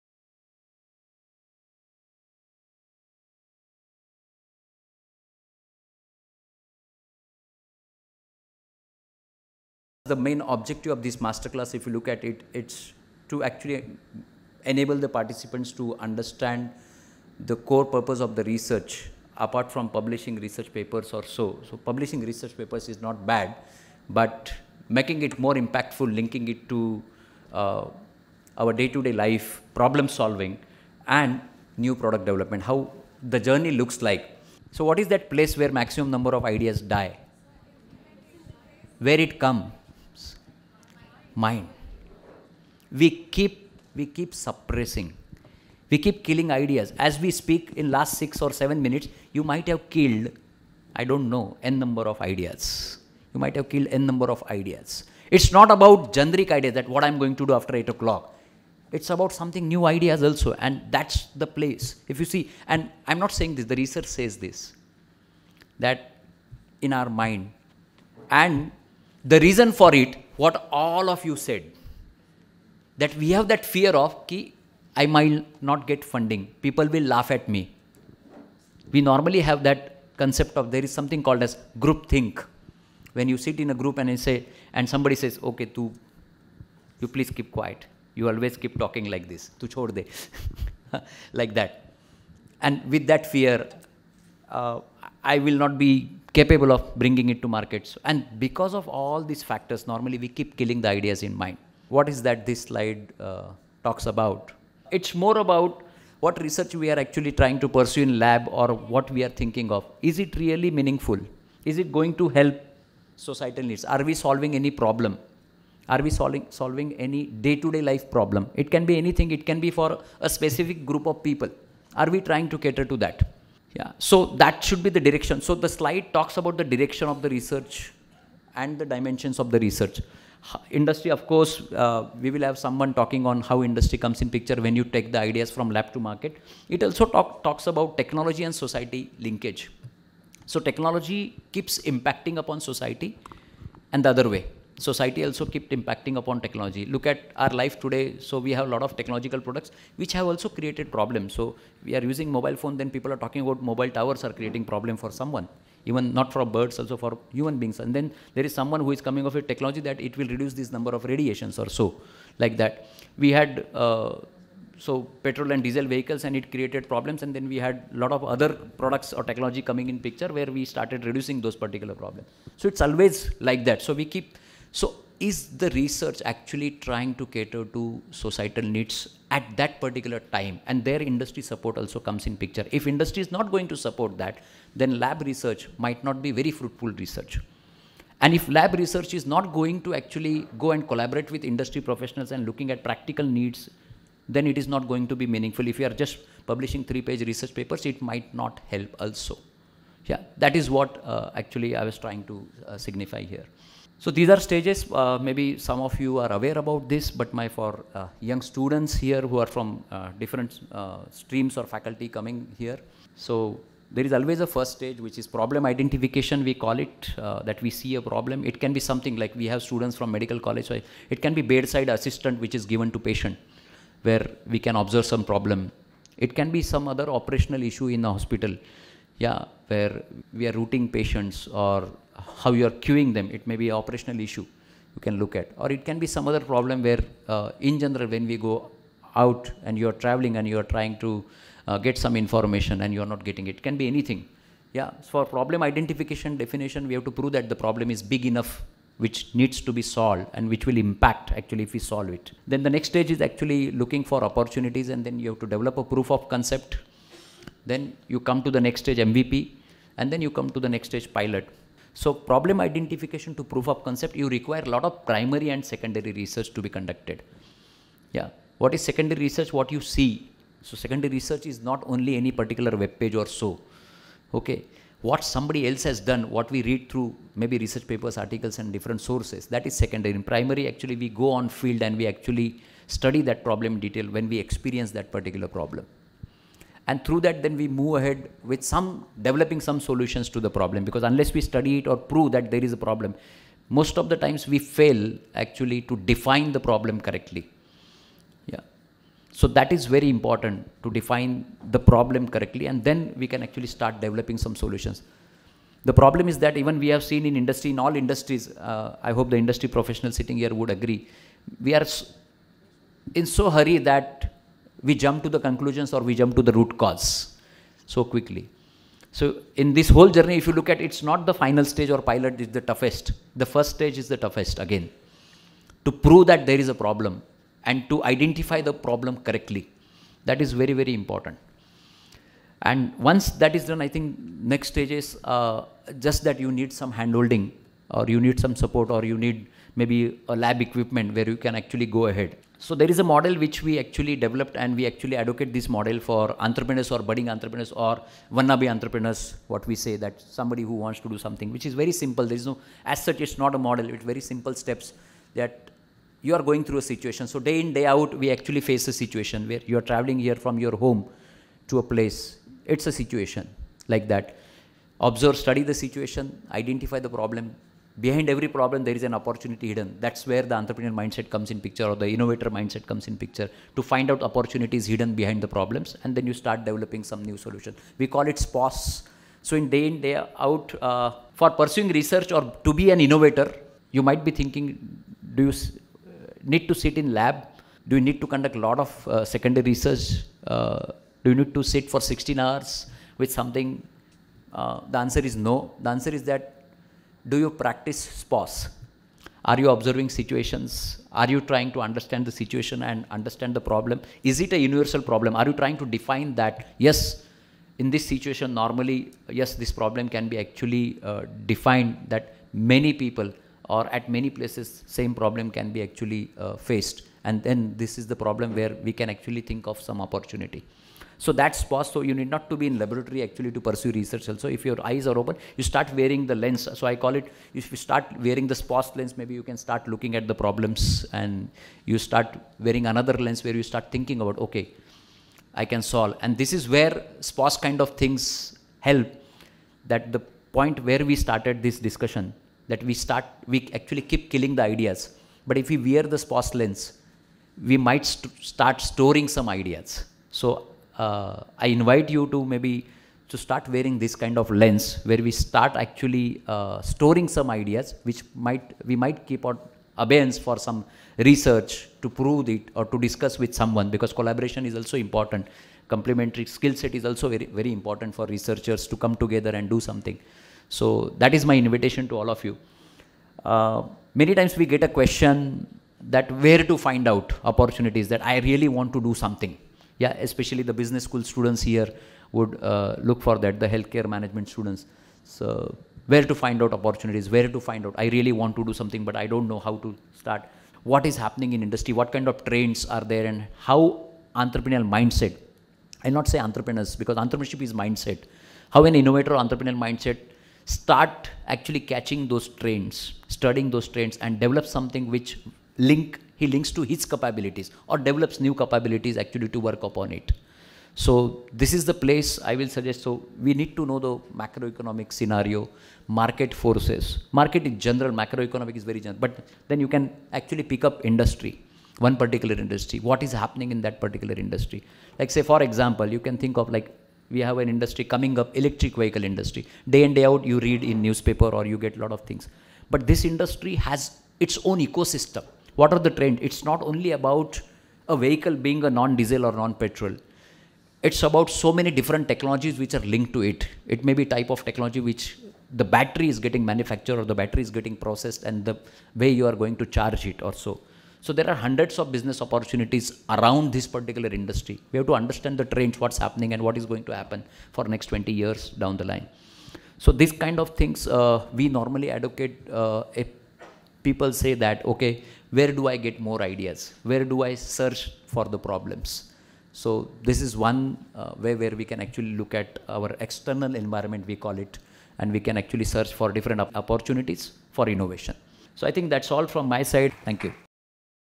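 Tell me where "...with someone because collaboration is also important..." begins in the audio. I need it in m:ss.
7:43.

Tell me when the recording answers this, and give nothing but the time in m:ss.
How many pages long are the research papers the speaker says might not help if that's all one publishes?
3:16.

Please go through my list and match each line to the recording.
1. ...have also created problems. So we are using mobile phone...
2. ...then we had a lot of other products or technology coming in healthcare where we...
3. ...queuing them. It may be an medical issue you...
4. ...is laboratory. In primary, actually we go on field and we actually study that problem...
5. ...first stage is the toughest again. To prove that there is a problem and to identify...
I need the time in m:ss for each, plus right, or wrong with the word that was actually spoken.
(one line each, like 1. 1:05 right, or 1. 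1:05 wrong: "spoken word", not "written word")
1. 2:30 right
2. 2:47 wrong: "picture", not "healthcare"
3. 3:52 wrong: "operational", not "medical"
4. 4:39 wrong: "secondary", not "laboratory"
5. 5:23 right.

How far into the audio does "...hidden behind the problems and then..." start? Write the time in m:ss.
6:14.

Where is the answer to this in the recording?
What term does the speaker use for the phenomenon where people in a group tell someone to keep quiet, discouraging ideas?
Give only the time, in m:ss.
1:21.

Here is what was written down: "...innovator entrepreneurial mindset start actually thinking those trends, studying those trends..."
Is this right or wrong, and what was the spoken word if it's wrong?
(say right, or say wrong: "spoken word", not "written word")
wrong: "catching", not "thinking".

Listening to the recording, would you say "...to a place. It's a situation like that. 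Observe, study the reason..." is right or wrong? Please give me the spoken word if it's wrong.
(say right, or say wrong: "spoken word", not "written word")
wrong: "situation", not "reason".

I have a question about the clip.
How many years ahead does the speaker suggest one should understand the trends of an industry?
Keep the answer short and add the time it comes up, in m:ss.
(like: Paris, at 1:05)
20, at 9:18.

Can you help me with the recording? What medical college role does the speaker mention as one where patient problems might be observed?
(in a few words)
bedside assistant.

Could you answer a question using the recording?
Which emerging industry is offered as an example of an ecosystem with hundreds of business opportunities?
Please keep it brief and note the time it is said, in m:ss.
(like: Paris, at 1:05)
electric vehicle industry, at 8:48.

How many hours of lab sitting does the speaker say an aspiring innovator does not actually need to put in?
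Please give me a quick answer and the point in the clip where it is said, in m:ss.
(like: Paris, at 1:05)
16, at 6:31.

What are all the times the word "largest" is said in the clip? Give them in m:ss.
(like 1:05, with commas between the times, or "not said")
not said.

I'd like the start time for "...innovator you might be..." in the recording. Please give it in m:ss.
6:23.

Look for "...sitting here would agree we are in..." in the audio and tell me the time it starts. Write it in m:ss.
5:10.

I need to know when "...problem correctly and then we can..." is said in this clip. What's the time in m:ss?
5:01.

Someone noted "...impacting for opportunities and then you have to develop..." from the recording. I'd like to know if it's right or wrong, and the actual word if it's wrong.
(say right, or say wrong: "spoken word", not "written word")
wrong: "looking", not "impacting".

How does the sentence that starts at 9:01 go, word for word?
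It's about so many different technologies which are linked to it.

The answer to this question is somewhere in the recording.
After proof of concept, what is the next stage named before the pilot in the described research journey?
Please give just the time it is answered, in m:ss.
4:18.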